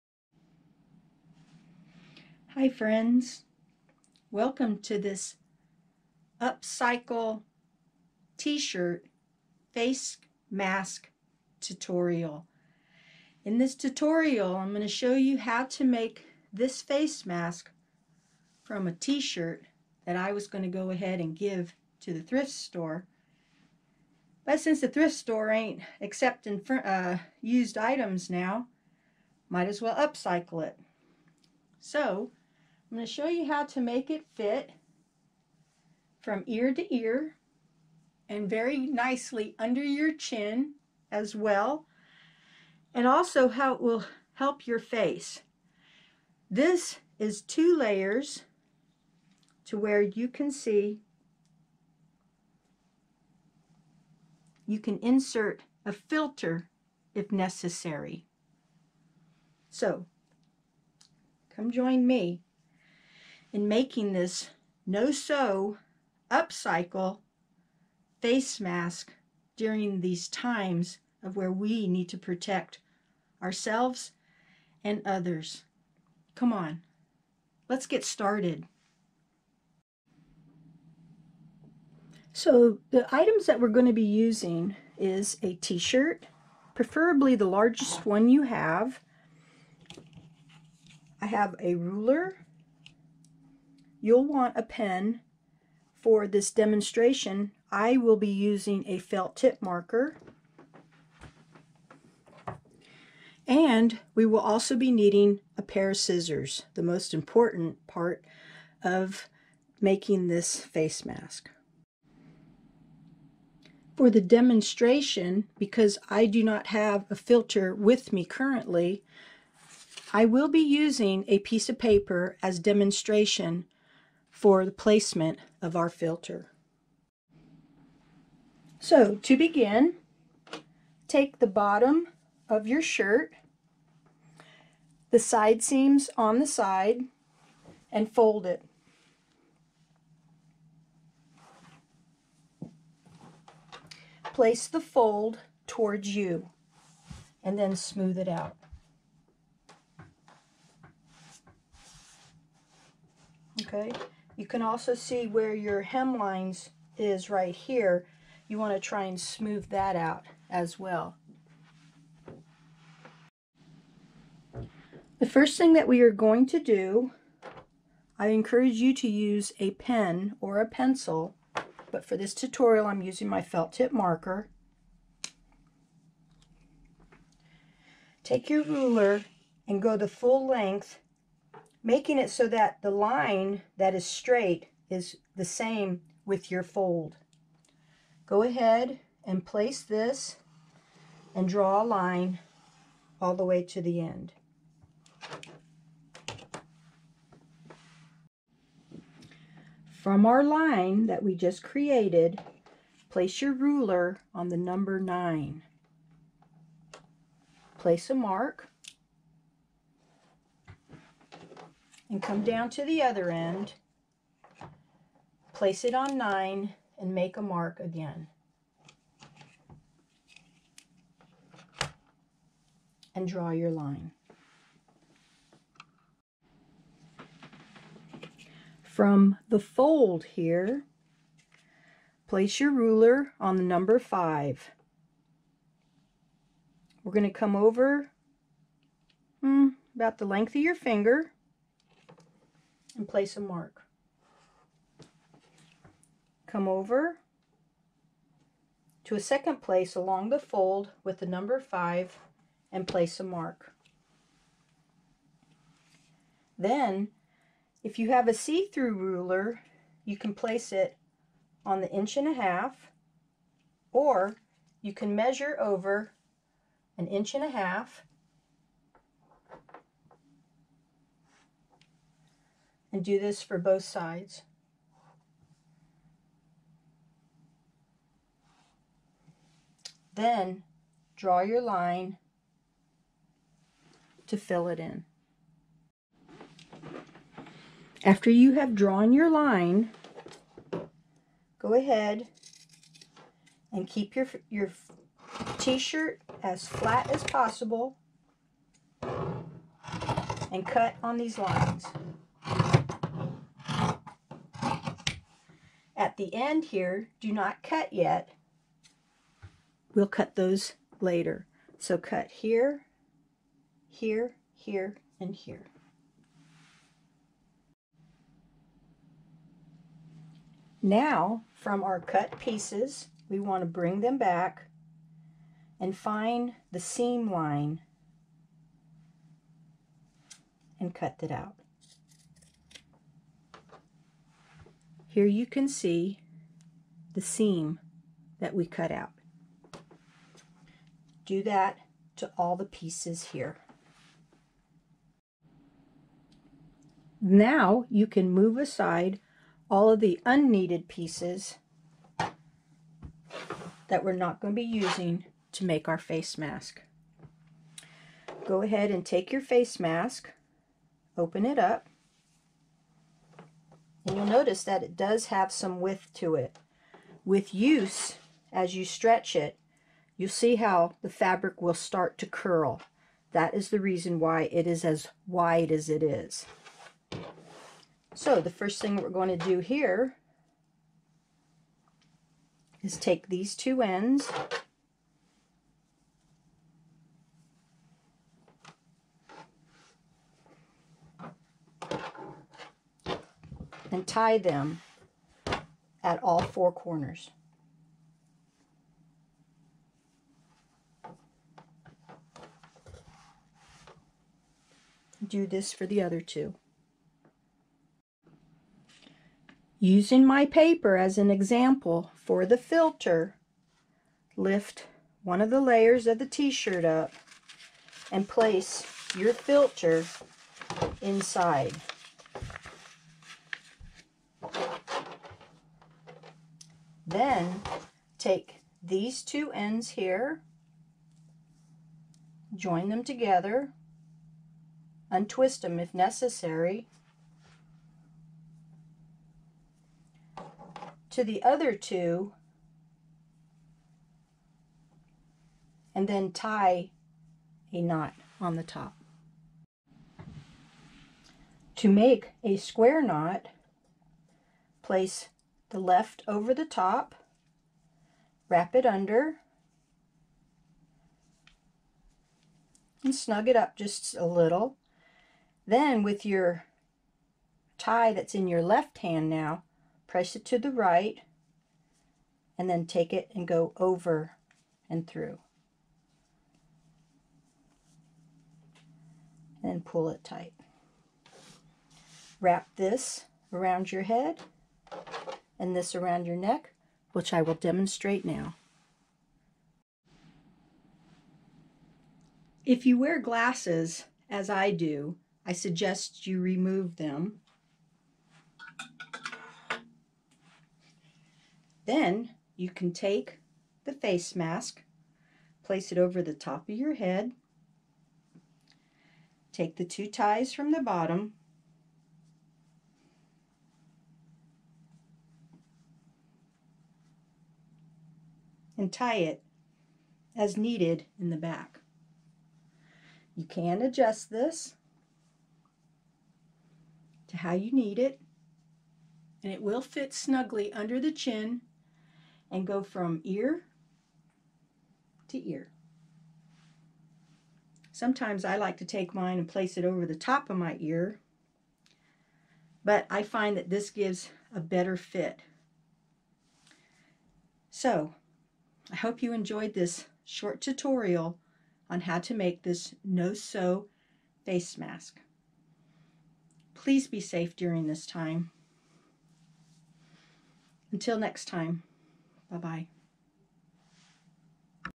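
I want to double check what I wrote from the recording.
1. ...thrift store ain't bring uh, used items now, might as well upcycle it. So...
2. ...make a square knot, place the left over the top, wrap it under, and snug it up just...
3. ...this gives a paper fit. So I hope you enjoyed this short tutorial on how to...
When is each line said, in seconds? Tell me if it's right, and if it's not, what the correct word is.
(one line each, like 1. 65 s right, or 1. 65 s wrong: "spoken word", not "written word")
1. 24 s wrong: "accepting", not "bring"
2. 451 s right
3. 543 s wrong: "better", not "paper".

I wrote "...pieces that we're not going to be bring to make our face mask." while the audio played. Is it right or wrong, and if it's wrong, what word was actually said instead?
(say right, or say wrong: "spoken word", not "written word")
wrong: "using", not "bring".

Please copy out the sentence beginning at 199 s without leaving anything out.
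From our line that we just created, place your ruler on the number 9.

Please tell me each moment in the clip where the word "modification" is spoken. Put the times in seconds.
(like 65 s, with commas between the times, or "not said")
not said.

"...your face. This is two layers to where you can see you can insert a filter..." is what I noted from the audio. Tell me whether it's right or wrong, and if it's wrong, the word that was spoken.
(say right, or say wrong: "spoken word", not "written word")
right.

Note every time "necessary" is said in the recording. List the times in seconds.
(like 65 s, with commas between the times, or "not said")
57 s, 435 s.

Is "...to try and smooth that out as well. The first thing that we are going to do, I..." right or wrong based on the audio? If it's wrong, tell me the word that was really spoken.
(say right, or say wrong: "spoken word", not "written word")
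right.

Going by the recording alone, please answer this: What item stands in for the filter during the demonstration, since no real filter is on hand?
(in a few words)
Piece of paper.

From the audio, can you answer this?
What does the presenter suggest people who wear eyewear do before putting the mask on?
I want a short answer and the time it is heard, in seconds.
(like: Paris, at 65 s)
Remove them, at 496 s.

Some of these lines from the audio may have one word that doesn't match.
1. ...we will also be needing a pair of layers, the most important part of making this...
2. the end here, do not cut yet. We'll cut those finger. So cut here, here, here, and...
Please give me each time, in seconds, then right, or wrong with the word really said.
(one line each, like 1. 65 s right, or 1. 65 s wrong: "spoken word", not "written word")
1. 104 s wrong: "scissors", not "layers"
2. 306 s wrong: "later", not "finger".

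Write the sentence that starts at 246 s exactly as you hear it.
Come over to a second place along the fold with the number 5 and place a mark.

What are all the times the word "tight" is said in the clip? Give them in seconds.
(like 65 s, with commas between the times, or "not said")
480 s.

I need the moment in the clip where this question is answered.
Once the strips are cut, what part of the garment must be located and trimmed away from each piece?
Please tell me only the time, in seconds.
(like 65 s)
326 s.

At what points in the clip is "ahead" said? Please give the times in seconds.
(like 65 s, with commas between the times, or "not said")
20 s, 188 s, 291 s, 358 s.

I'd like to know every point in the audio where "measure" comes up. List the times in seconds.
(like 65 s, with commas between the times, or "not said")
265 s.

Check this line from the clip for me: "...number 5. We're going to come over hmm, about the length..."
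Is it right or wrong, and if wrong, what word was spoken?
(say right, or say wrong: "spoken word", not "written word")
right.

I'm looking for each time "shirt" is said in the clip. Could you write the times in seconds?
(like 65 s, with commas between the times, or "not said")
8 s, 18 s, 85 s, 132 s, 295 s, 416 s.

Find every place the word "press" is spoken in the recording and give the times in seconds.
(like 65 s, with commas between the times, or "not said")
470 s.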